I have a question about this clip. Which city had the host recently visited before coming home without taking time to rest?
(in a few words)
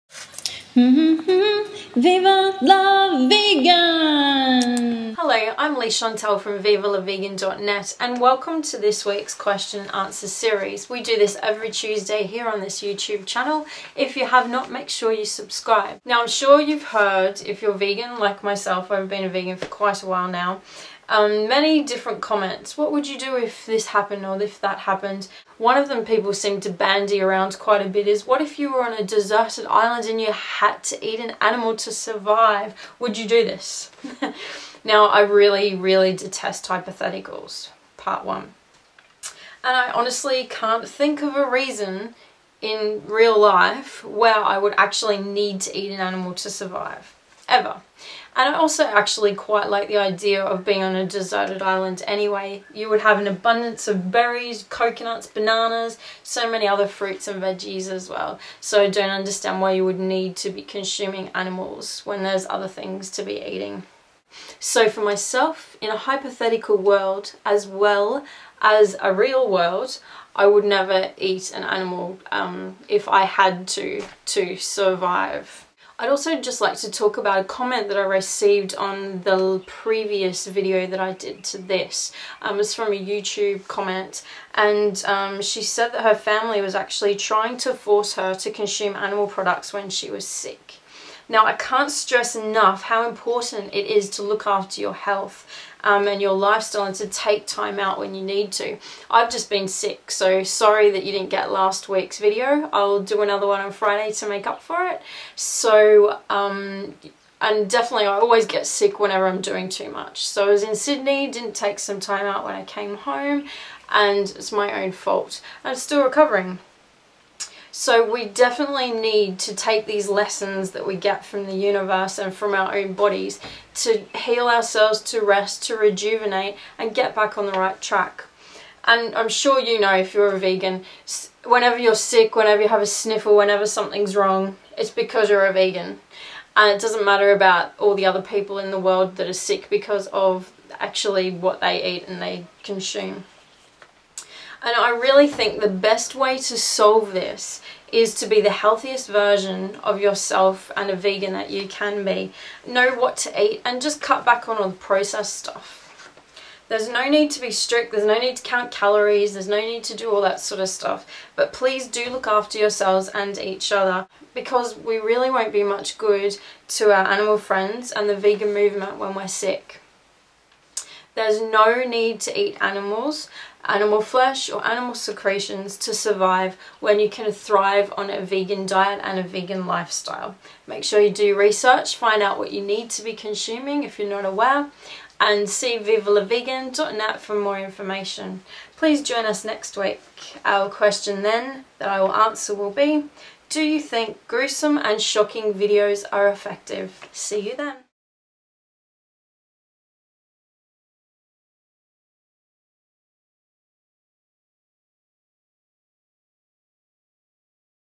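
Sydney.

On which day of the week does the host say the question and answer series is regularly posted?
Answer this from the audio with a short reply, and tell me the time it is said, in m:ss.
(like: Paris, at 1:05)
Tuesday, at 0:11.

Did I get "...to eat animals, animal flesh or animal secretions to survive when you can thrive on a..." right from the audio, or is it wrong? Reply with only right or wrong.
right.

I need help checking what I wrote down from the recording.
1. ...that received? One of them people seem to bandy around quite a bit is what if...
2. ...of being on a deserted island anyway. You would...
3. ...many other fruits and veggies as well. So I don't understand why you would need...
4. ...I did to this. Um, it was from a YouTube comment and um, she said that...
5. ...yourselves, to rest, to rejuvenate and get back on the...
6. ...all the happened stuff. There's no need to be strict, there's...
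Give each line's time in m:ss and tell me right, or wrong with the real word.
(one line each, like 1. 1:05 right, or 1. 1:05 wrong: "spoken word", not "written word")
1. 0:24 wrong: "happened", not "received"
2. 0:50 right
3. 0:56 right
4. 1:20 right
5. 2:04 wrong: "ourselves", not "yourselves"
6. 2:34 wrong: "processed", not "happened".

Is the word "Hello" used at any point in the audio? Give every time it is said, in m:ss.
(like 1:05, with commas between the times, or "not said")
0:05.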